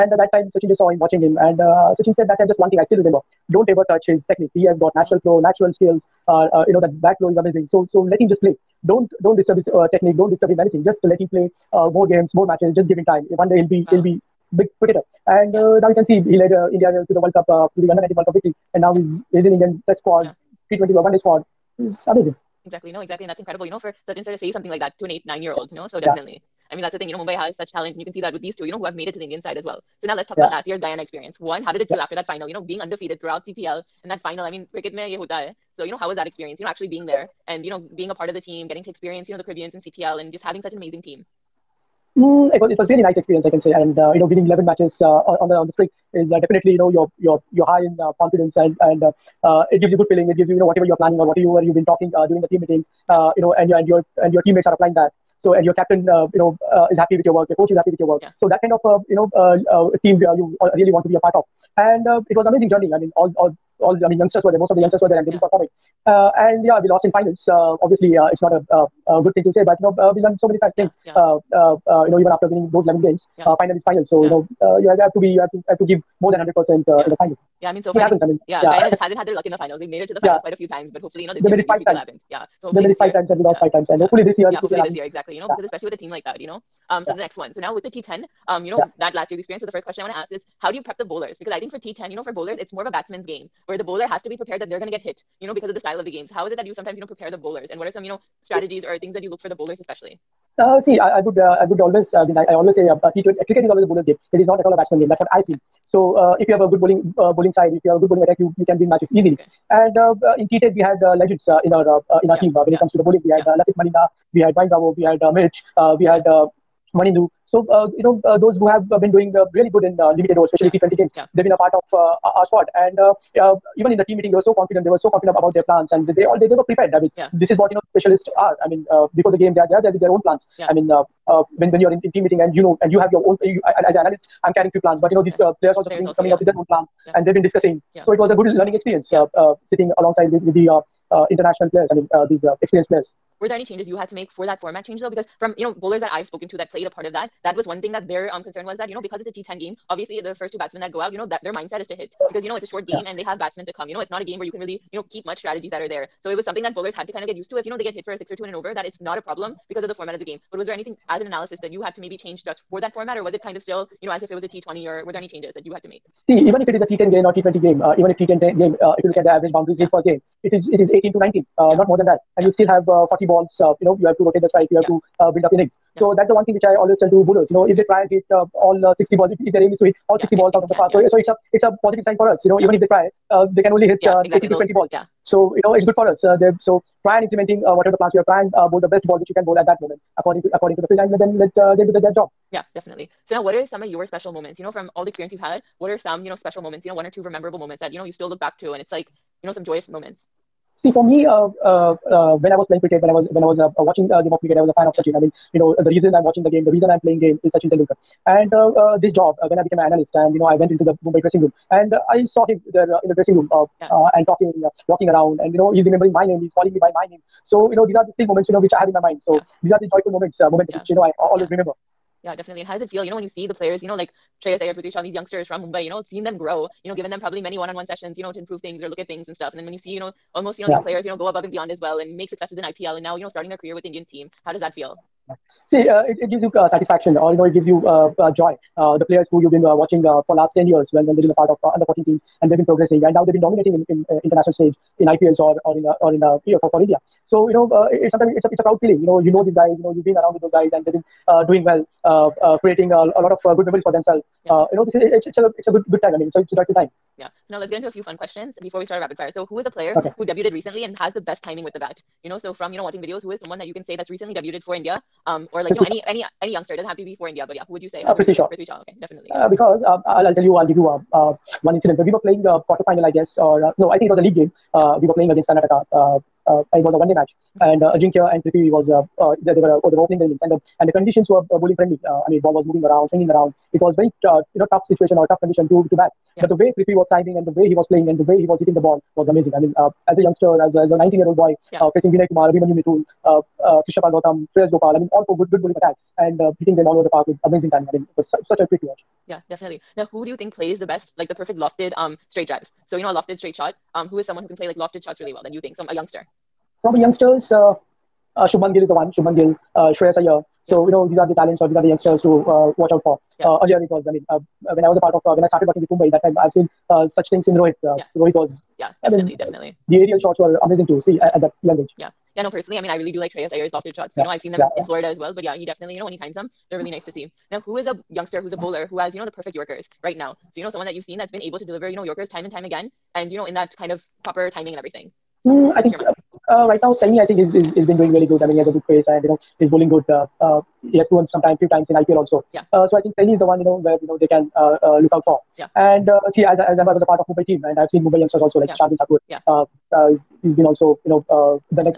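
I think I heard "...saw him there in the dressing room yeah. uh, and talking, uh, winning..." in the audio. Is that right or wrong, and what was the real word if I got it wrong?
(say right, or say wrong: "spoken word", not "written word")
wrong: "walking", not "winning".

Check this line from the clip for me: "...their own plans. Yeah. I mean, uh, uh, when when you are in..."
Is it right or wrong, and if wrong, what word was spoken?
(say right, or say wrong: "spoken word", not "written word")
right.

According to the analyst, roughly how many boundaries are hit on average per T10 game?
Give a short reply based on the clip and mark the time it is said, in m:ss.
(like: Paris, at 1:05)
18 to 19, at 2:50.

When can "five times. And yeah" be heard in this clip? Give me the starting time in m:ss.
1:23.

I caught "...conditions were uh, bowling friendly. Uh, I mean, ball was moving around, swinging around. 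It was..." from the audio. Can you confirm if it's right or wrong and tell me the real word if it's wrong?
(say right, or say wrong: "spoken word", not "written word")
right.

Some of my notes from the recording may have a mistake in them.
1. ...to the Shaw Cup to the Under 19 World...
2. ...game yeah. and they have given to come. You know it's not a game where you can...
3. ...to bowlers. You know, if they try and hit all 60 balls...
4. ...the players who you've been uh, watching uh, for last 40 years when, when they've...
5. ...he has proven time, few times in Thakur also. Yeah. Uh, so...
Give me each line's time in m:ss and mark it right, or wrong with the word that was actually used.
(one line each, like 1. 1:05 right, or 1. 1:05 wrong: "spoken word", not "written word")
1. 0:17 wrong: "World", not "Shaw"
2. 2:32 wrong: "batsmen", not "given"
3. 2:57 right
4. 3:58 wrong: "10", not "40"
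5. 5:40 wrong: "IPL", not "Thakur".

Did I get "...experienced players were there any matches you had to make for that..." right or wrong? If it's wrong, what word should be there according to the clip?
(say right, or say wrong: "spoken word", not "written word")
wrong: "changes", not "matches".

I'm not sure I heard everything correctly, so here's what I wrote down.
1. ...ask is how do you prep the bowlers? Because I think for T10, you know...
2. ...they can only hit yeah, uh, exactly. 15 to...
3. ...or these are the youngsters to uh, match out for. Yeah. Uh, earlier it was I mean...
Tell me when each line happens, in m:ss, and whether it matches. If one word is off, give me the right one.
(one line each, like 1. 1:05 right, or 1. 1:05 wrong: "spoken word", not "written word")
1. 1:30 right
2. 3:03 wrong: "18", not "15"
3. 5:11 wrong: "watch", not "match".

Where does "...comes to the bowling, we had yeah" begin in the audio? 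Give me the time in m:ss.
1:52.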